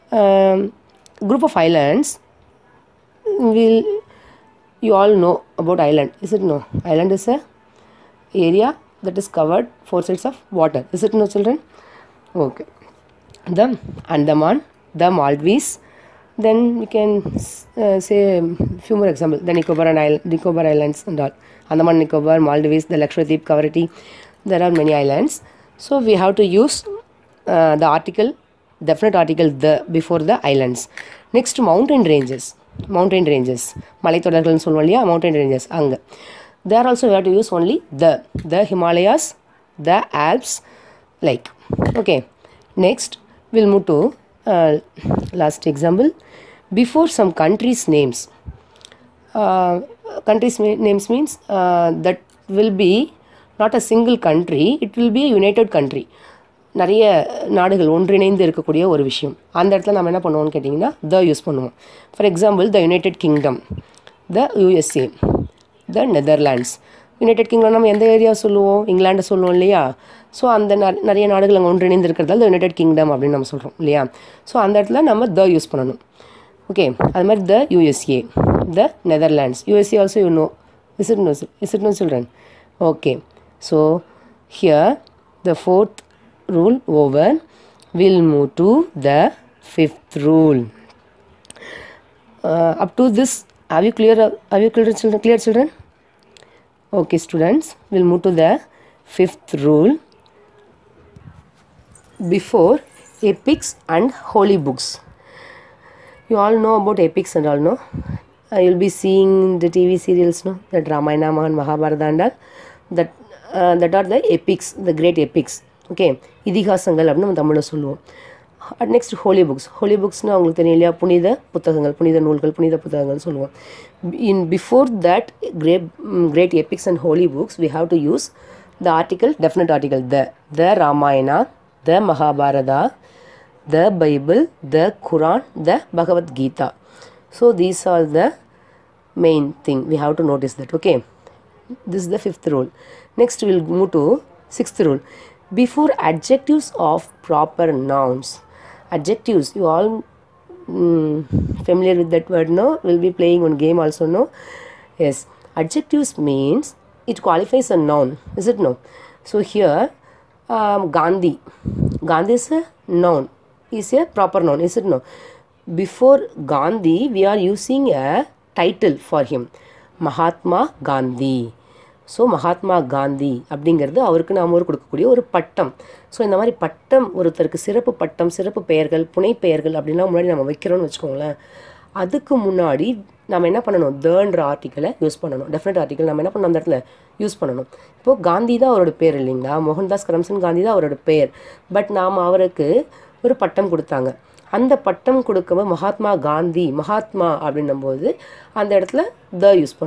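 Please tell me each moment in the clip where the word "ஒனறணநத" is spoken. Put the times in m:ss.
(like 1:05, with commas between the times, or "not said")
0:57, 1:11.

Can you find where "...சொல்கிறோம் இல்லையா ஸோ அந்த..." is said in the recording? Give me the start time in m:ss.
1:13.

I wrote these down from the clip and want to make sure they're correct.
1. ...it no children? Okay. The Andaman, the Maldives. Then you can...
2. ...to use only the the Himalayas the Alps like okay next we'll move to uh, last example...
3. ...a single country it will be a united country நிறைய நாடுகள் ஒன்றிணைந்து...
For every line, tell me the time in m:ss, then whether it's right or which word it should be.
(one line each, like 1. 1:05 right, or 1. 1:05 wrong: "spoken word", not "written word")
1. 0:11 right
2. 0:37 right
3. 0:53 right.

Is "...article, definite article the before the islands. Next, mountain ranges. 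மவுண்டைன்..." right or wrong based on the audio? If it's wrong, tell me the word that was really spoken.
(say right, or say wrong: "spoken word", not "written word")
right.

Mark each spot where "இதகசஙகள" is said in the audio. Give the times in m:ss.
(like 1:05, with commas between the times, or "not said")
1:56.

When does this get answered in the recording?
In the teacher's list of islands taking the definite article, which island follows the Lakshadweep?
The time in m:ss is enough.
0:23.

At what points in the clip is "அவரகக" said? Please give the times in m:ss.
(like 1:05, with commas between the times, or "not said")
2:54, 3:12.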